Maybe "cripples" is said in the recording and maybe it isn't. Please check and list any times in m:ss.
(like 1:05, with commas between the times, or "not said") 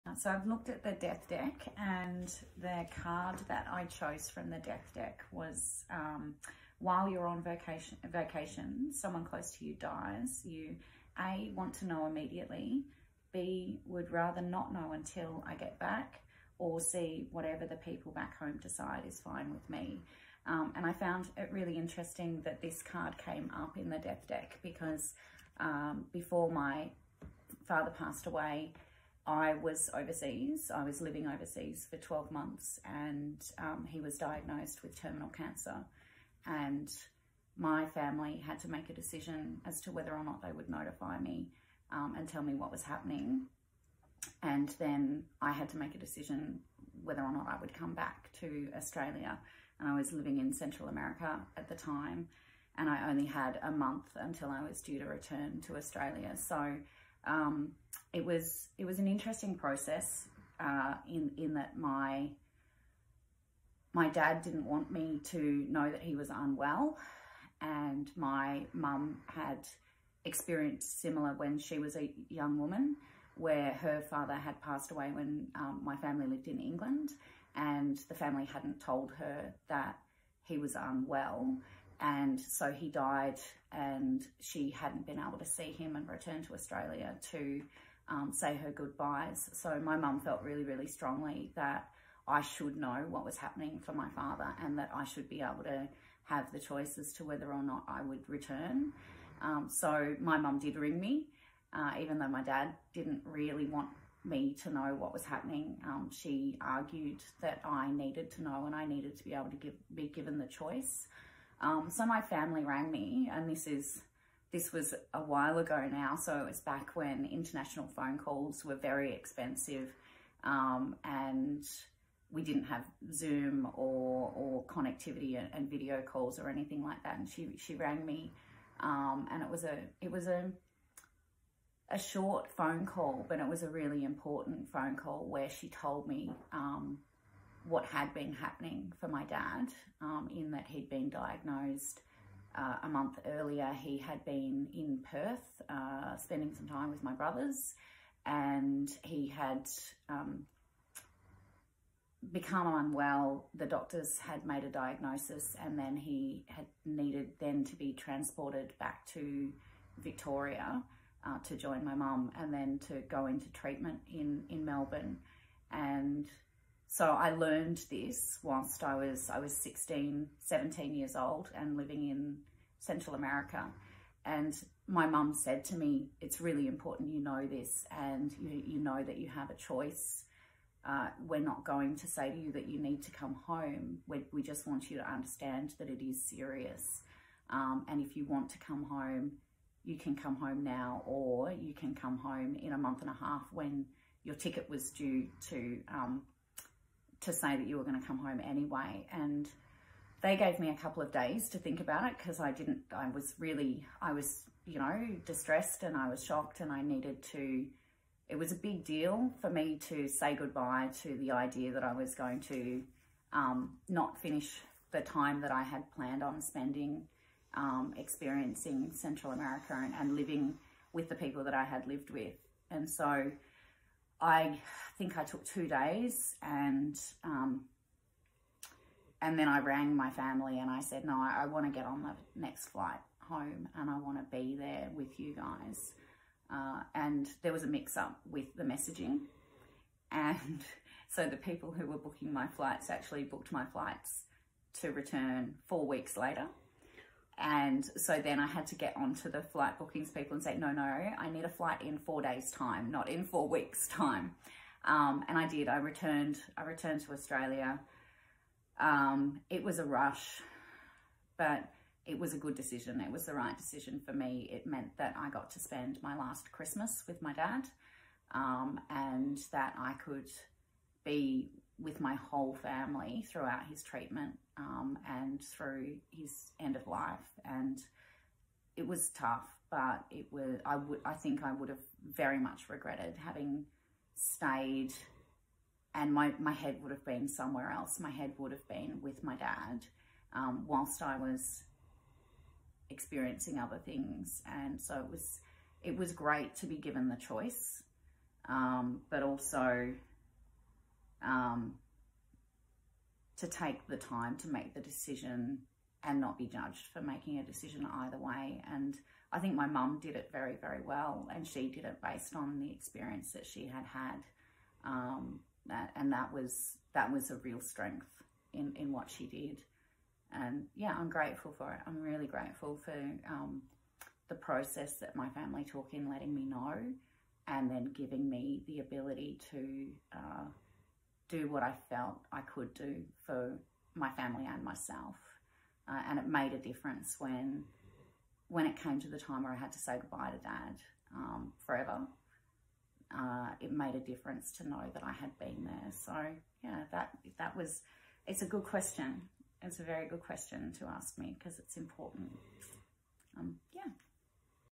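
not said.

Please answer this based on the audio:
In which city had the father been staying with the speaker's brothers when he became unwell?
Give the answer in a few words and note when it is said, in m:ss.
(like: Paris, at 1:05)
Perth, at 2:25.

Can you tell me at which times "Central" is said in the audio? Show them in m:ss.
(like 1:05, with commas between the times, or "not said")
0:50, 2:52, 3:38.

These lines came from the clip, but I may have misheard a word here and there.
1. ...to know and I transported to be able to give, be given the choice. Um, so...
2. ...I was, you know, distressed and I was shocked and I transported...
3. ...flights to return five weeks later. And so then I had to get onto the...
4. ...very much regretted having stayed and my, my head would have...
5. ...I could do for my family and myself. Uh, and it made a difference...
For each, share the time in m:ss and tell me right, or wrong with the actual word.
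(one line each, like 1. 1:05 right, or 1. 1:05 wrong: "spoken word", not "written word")
1. 1:48 wrong: "needed", not "transported"
2. 3:24 wrong: "needed", not "transported"
3. 4:03 wrong: "four", not "five"
4. 4:42 right
5. 5:32 right.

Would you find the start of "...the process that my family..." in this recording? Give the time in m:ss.
5:24.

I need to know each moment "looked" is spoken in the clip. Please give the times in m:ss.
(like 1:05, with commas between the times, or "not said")
0:00.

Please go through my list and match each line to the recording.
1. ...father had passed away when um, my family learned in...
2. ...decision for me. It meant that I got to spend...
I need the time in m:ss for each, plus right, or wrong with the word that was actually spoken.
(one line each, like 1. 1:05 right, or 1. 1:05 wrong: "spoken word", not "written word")
1. 1:14 wrong: "lived", not "learned"
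2. 4:23 right.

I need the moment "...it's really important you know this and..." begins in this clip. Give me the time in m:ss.
2:56.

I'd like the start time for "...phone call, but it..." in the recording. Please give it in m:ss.
2:12.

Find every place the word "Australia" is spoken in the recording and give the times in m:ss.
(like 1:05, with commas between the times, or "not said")
0:48, 0:55, 1:26, 4:17.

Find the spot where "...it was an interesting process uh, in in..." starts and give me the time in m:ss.
0:58.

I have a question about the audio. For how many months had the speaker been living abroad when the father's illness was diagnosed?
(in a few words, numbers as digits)
12.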